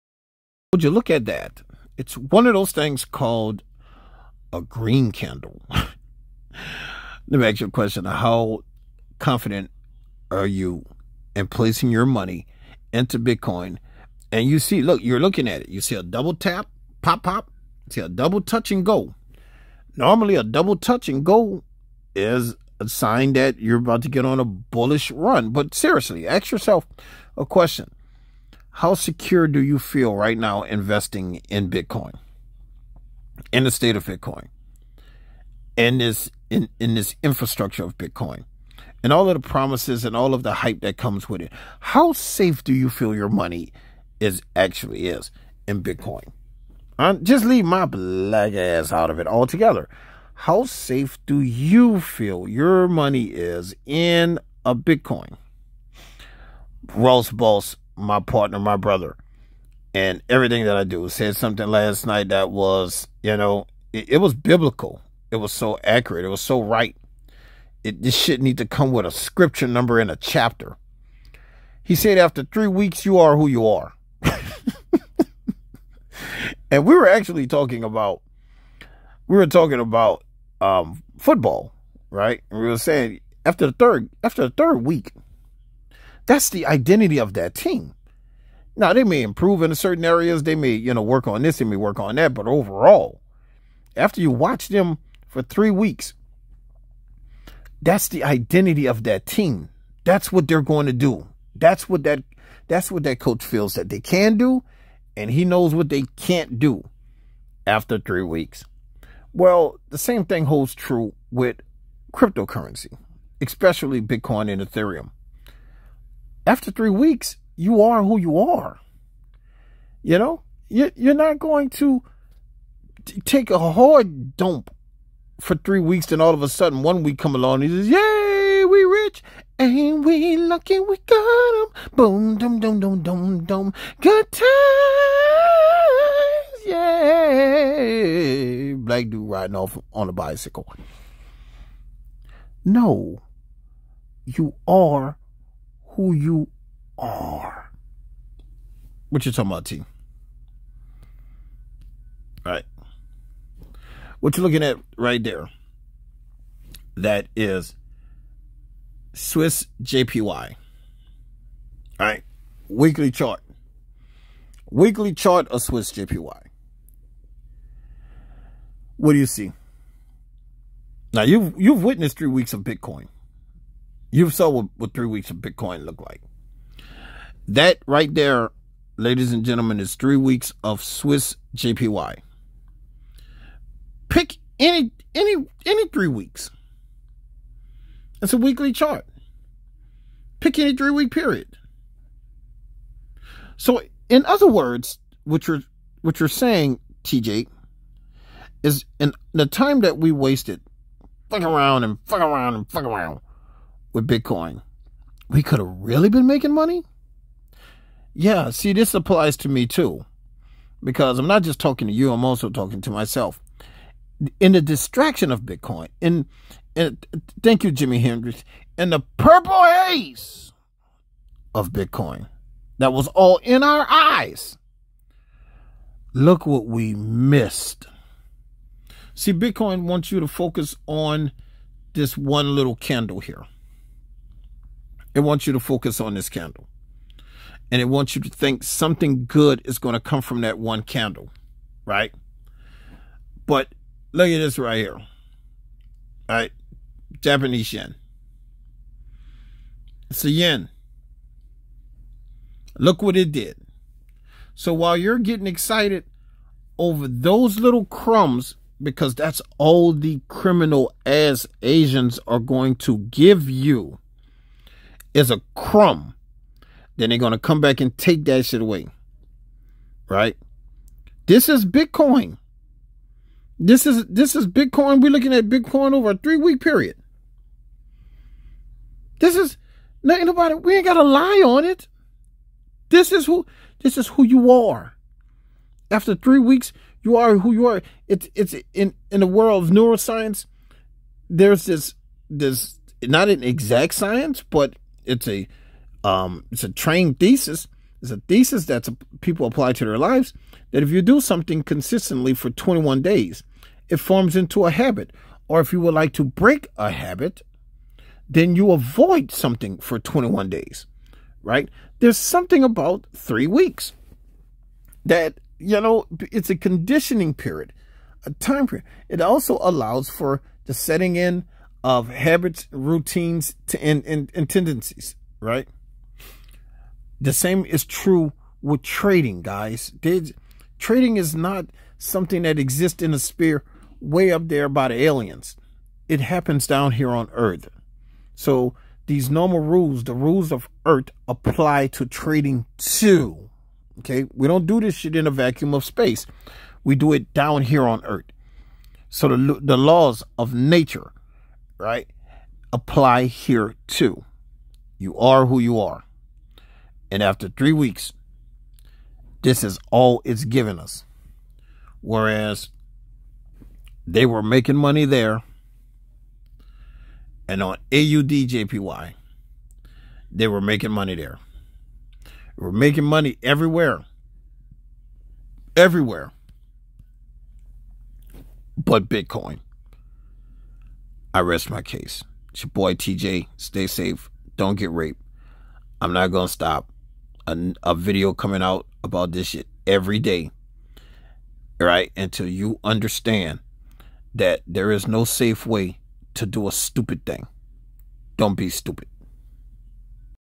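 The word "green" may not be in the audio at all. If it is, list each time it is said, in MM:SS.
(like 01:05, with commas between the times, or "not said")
00:04.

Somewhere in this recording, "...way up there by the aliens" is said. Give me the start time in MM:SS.
05:33.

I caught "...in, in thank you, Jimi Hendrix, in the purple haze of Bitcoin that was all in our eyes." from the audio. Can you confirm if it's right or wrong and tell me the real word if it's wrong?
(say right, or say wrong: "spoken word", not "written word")
right.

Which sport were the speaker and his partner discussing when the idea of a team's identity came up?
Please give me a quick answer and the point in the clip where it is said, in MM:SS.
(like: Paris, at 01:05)
Football, at 01:21.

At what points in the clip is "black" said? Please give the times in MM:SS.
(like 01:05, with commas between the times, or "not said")
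00:47, 02:18.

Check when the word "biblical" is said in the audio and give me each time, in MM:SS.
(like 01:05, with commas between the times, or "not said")
01:04.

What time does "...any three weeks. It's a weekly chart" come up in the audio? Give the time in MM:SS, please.
03:05.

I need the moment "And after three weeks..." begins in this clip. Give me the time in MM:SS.
05:57.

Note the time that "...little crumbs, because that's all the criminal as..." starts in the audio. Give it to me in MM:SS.
04:17.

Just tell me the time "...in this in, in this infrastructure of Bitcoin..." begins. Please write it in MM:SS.
00:35.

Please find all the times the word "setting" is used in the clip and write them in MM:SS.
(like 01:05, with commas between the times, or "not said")
05:20.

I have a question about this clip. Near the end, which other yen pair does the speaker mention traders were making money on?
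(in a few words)
AUDJPY.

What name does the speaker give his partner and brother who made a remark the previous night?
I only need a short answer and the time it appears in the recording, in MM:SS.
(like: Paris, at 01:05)
Ross Boss, at 00:56.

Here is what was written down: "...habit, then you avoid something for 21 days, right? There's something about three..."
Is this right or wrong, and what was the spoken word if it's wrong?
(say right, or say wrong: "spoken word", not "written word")
right.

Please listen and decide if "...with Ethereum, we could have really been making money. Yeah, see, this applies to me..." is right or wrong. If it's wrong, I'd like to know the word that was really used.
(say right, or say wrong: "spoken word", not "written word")
wrong: "Bitcoin", not "Ethereum".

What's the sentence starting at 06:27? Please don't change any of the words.
A, a video coming out about this shit every day.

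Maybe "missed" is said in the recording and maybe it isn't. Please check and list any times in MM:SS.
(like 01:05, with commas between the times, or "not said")
03:46.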